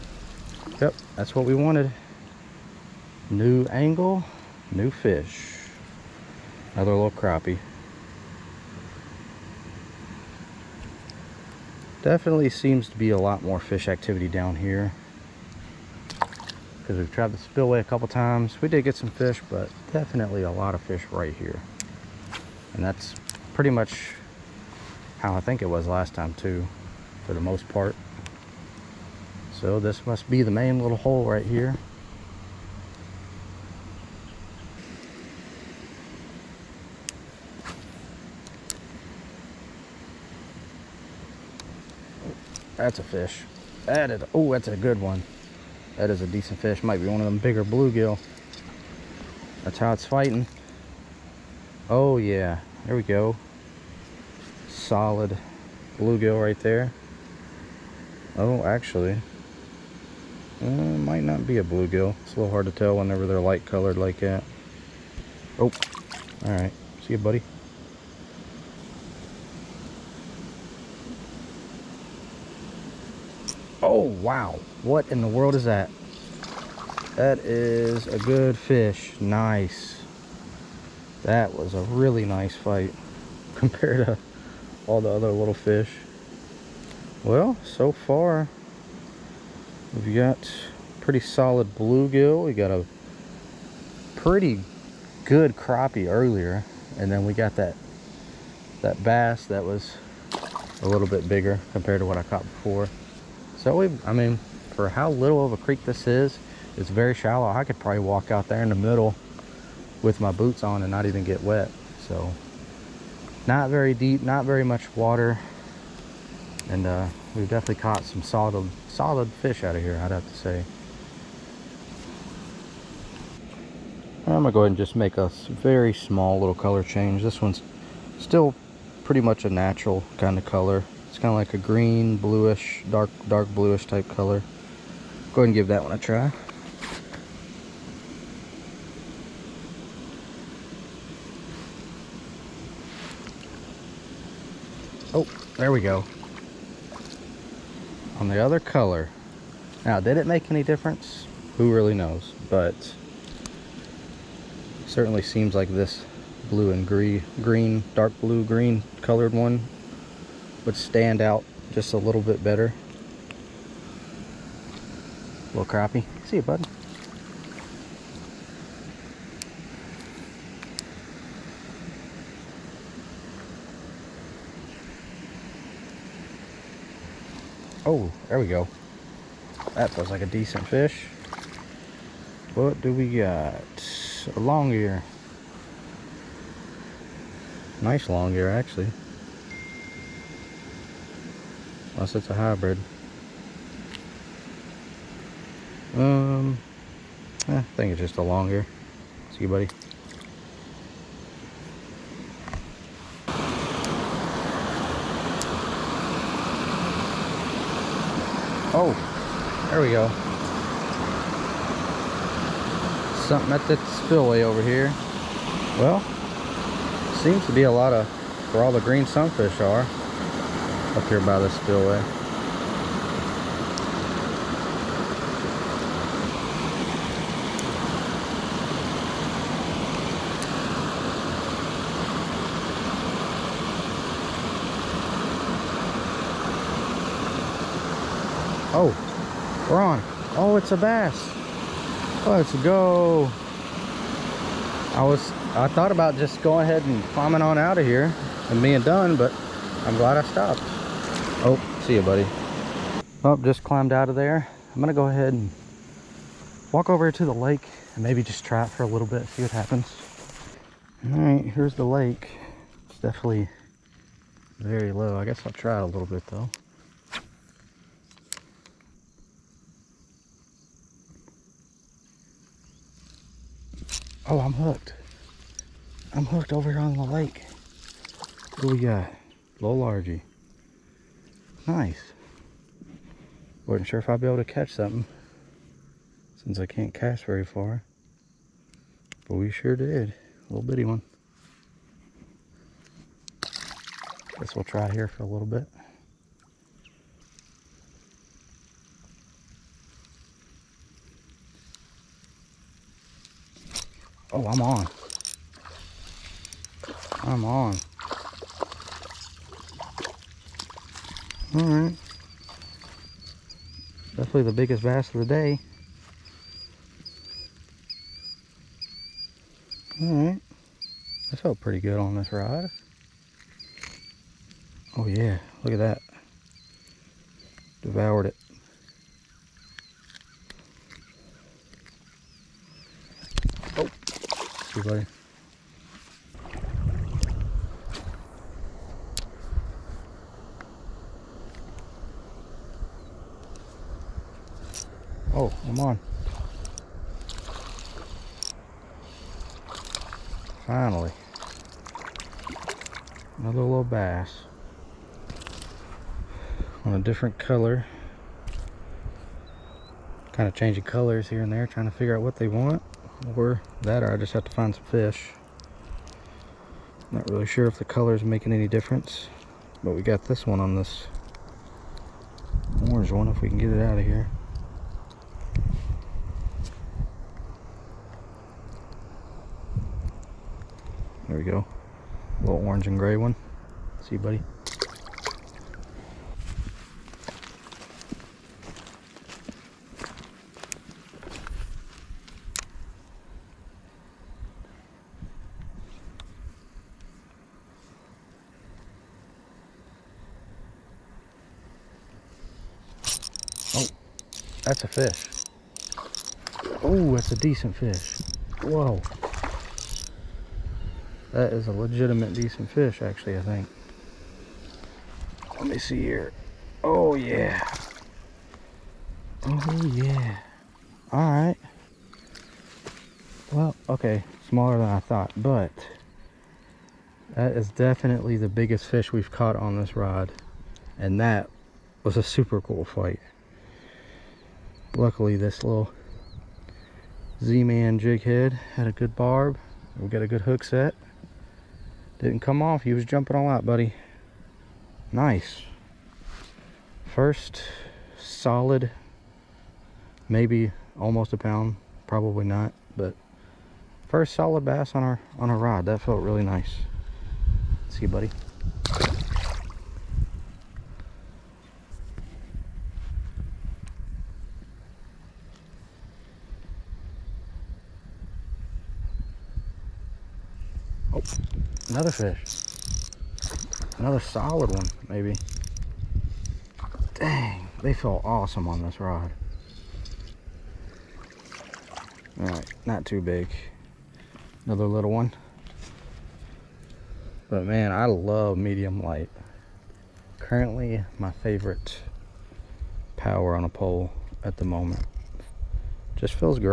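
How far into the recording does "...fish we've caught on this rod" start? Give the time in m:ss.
7:08.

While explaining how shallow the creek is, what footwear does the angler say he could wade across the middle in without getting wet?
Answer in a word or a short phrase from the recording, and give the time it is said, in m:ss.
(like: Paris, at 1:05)
boots, at 1:50.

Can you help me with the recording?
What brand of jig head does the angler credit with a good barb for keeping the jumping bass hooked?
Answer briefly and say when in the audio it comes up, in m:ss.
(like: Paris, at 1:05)
Z-Man, at 7:17.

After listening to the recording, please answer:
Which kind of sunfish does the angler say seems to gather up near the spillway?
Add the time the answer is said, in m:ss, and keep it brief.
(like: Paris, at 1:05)
green sunfish, at 3:38.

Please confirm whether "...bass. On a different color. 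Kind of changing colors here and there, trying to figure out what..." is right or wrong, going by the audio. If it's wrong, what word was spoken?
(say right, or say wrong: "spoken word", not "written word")
right.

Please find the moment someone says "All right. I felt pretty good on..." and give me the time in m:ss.
5:20.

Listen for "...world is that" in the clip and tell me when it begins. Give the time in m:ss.
1:15.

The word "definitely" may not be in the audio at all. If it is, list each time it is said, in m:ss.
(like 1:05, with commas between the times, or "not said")
0:12, 0:19, 1:57, 4:22, 5:14, 7:07.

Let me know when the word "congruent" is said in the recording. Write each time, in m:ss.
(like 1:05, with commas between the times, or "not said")
not said.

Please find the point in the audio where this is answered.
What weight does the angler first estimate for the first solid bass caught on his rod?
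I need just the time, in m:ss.
7:30.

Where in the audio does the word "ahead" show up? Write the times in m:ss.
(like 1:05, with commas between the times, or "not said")
2:04, 2:15, 4:06, 4:15.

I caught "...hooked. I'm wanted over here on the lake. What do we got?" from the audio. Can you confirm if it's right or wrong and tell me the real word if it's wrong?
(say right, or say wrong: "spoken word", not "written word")
wrong: "hooked", not "wanted".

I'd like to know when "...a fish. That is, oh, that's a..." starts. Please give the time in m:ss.
0:42.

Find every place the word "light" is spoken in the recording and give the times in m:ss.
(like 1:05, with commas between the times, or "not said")
1:03, 8:09.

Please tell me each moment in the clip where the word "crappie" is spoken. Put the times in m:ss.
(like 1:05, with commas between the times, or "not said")
0:07, 1:35, 2:45.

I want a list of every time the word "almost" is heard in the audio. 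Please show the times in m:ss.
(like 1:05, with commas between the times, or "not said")
7:30.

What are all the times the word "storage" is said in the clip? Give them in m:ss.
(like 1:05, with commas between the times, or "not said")
not said.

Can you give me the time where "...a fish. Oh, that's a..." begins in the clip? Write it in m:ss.
6:44.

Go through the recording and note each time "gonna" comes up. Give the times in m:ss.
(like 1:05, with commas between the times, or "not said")
2:04, 4:14.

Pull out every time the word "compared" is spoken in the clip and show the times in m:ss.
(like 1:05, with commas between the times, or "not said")
1:23, 1:41.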